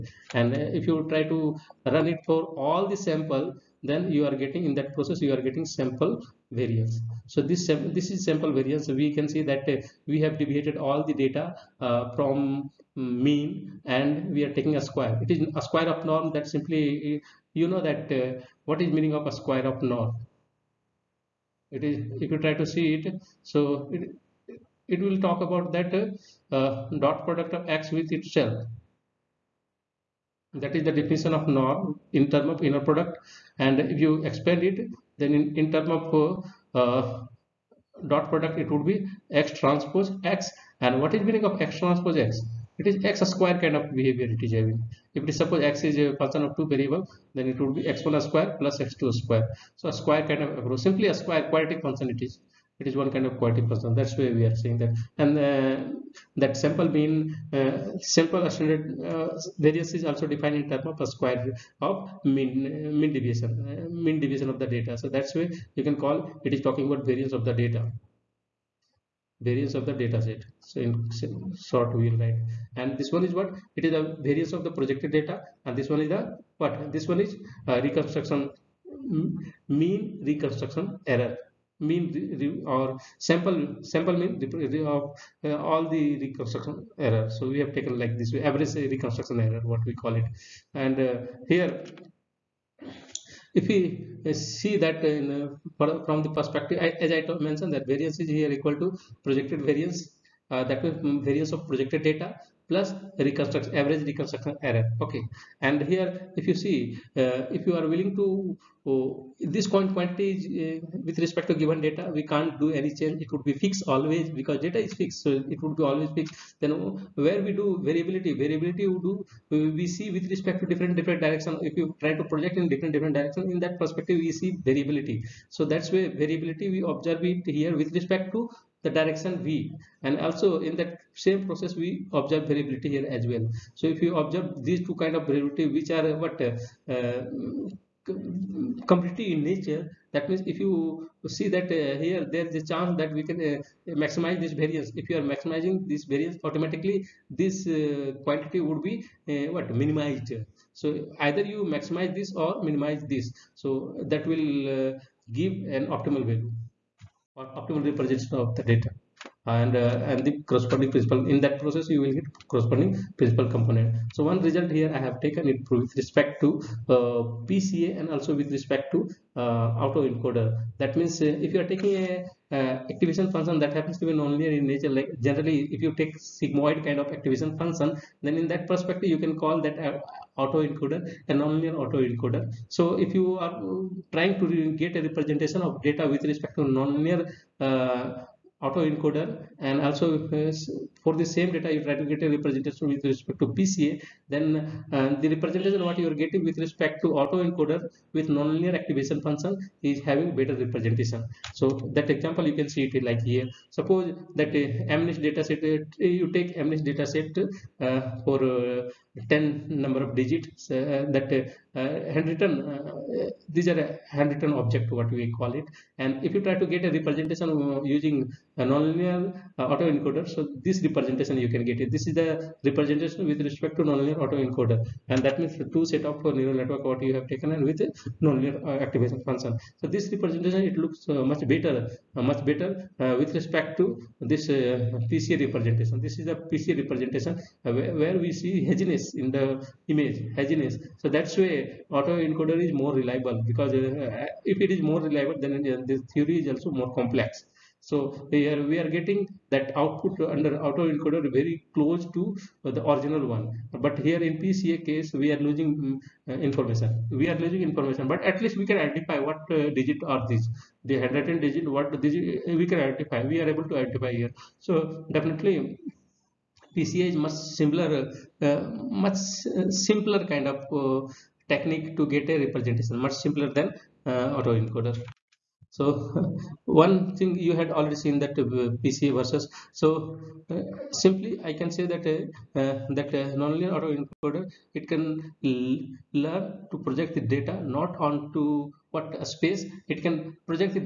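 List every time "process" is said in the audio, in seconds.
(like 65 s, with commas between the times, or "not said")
4 s, 131 s, 161 s.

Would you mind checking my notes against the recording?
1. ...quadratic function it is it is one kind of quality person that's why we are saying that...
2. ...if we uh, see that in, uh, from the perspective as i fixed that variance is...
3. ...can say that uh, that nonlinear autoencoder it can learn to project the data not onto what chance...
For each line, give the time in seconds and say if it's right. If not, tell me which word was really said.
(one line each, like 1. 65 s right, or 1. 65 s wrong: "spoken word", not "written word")
1. 51 s right
2. 93 s wrong: "mentioned", not "fixed"
3. 281 s wrong: "space", not "chance".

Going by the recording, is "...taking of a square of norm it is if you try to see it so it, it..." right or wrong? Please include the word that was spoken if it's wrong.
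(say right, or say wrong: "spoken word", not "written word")
wrong: "meaning", not "taking".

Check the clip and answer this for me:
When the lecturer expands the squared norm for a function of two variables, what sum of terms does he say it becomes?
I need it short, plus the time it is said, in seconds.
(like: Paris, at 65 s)
x1 square plus x2 square, at 47 s.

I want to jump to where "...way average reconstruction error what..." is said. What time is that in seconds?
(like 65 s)
88 s.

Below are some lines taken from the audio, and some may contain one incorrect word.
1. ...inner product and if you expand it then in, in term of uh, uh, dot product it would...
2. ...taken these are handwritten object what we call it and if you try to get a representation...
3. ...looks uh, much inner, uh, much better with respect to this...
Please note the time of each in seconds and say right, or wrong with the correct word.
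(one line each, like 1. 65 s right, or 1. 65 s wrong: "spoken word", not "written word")
1. 32 s right
2. 212 s wrong: "handwritten", not "taken"
3. 230 s wrong: "better", not "inner".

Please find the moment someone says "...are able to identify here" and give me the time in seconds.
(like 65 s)
263 s.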